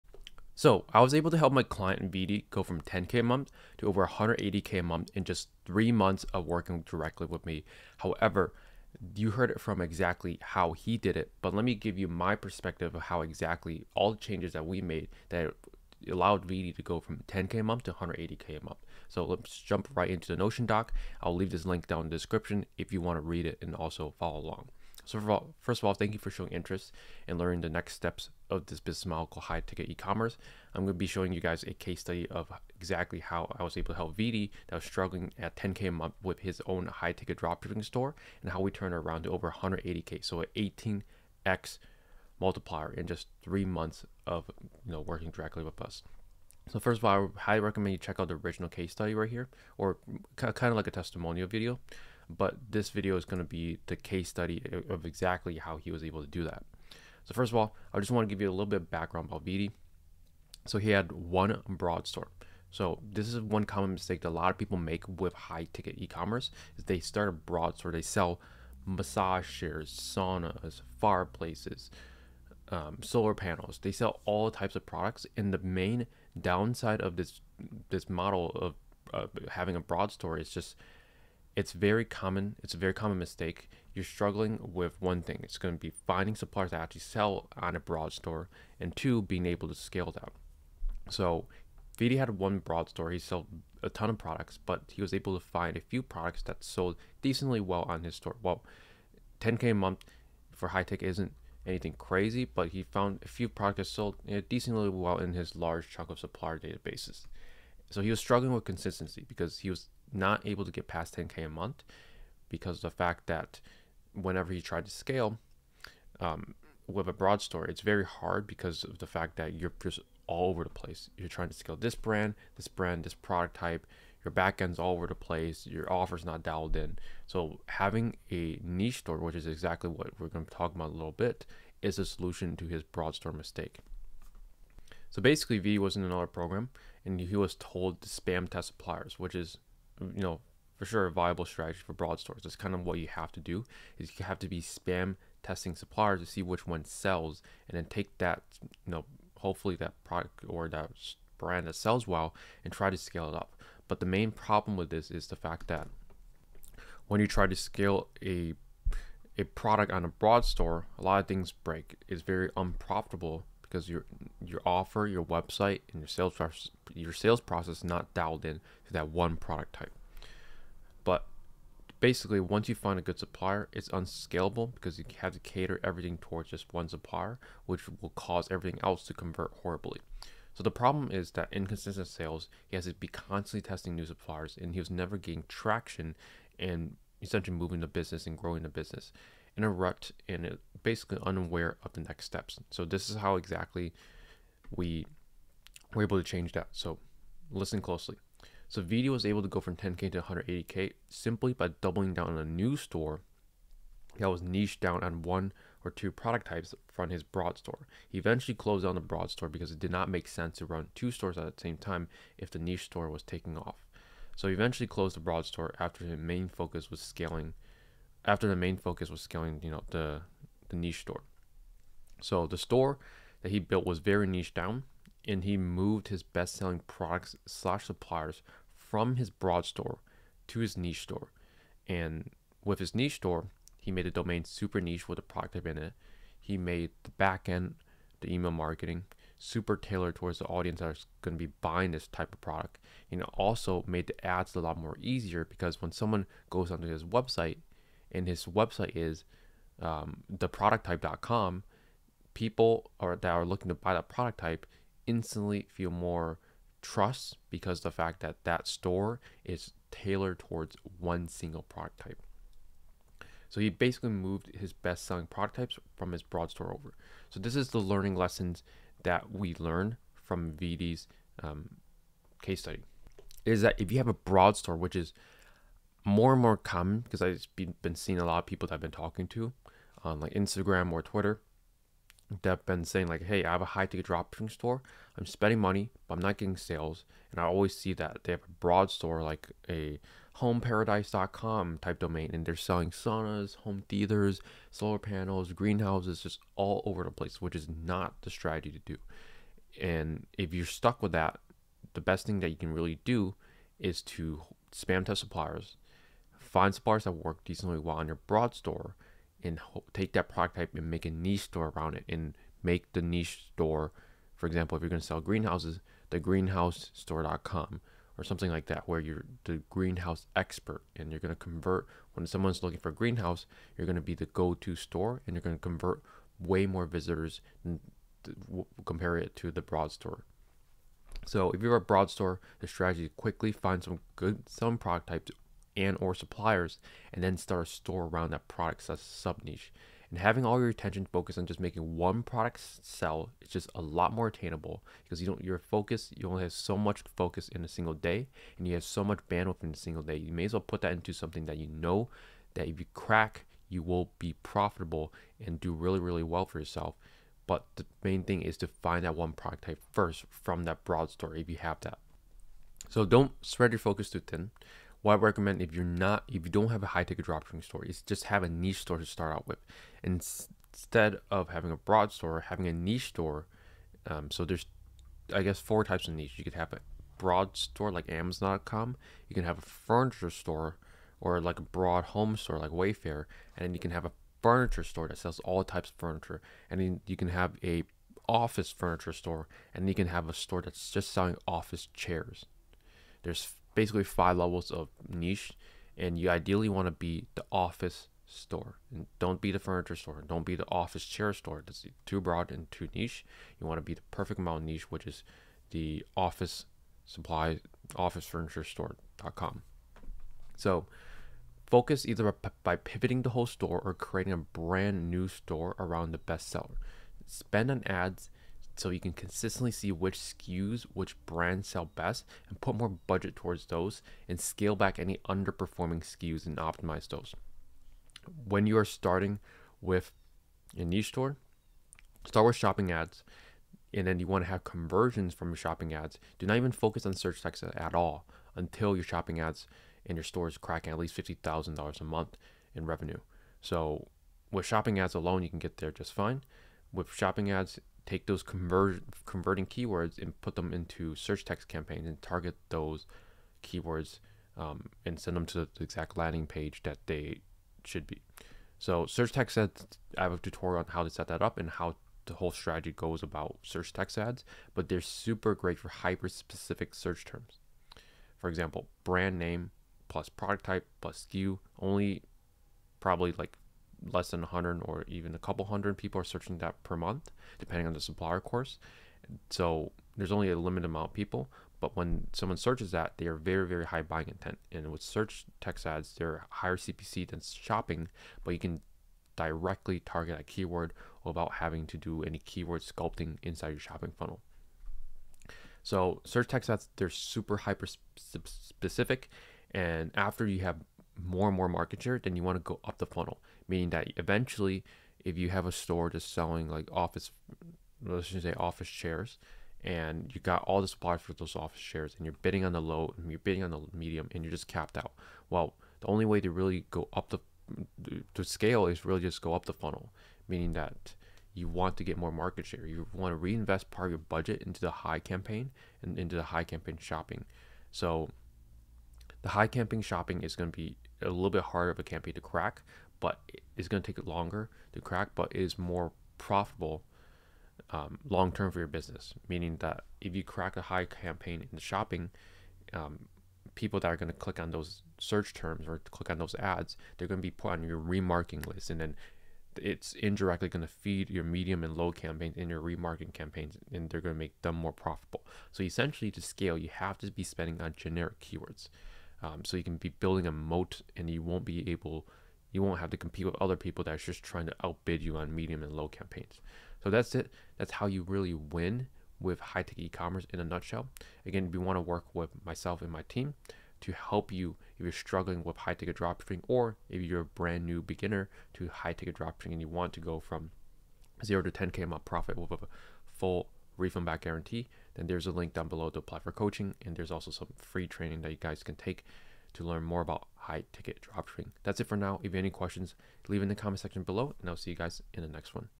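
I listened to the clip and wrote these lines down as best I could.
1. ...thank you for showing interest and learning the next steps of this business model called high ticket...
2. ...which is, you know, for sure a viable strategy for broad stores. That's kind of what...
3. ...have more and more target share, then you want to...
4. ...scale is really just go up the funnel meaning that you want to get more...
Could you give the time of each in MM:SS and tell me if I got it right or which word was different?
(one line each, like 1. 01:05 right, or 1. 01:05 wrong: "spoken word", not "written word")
1. 00:25 right
2. 02:19 right
3. 08:20 wrong: "market", not "target"
4. 08:38 right.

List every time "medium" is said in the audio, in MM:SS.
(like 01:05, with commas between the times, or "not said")
08:33, 09:11, 09:25.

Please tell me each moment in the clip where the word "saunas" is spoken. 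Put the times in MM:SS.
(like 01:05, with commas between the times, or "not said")
01:09, 04:52.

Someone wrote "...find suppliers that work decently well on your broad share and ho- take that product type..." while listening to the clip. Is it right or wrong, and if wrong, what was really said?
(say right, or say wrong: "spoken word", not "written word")
wrong: "store", not "share".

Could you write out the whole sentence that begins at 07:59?
So there's only a limited amount of people, but when someone searches that, they are very, very high buying intent.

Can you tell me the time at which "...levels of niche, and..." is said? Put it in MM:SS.
06:34.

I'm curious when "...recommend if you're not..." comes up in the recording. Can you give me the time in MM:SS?
06:05.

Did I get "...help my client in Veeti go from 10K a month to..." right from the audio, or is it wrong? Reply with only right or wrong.
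right.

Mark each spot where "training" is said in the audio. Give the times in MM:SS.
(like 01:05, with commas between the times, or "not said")
09:48.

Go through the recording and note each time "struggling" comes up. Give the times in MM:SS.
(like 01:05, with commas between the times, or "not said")
00:34, 01:24, 01:48, 09:35.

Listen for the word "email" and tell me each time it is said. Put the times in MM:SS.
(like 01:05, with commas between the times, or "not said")
03:58.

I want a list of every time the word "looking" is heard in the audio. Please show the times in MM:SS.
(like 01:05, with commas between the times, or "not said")
04:13, 05:22.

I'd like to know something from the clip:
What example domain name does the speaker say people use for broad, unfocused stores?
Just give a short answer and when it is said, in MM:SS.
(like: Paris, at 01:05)
homeparadise.com, at 04:50.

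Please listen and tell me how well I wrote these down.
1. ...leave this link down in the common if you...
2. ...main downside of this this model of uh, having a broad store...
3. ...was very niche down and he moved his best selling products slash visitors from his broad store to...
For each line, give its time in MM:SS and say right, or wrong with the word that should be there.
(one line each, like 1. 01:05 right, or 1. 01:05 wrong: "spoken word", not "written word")
1. 00:21 wrong: "description", not "common"
2. 01:15 right
3. 03:43 wrong: "suppliers", not "visitors".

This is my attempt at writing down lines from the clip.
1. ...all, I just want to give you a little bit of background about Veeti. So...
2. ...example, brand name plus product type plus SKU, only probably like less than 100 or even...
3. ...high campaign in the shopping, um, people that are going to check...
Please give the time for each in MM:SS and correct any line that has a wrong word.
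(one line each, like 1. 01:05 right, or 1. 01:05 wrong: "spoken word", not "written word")
1. 00:57 right
2. 07:48 right
3. 09:00 wrong: "click", not "check".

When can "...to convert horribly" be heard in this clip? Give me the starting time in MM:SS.
02:59.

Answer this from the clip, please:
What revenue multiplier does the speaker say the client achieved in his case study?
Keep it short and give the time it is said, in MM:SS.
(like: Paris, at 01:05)
18x, at 00:41.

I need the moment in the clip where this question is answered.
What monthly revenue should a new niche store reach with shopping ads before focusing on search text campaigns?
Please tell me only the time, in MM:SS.
07:21.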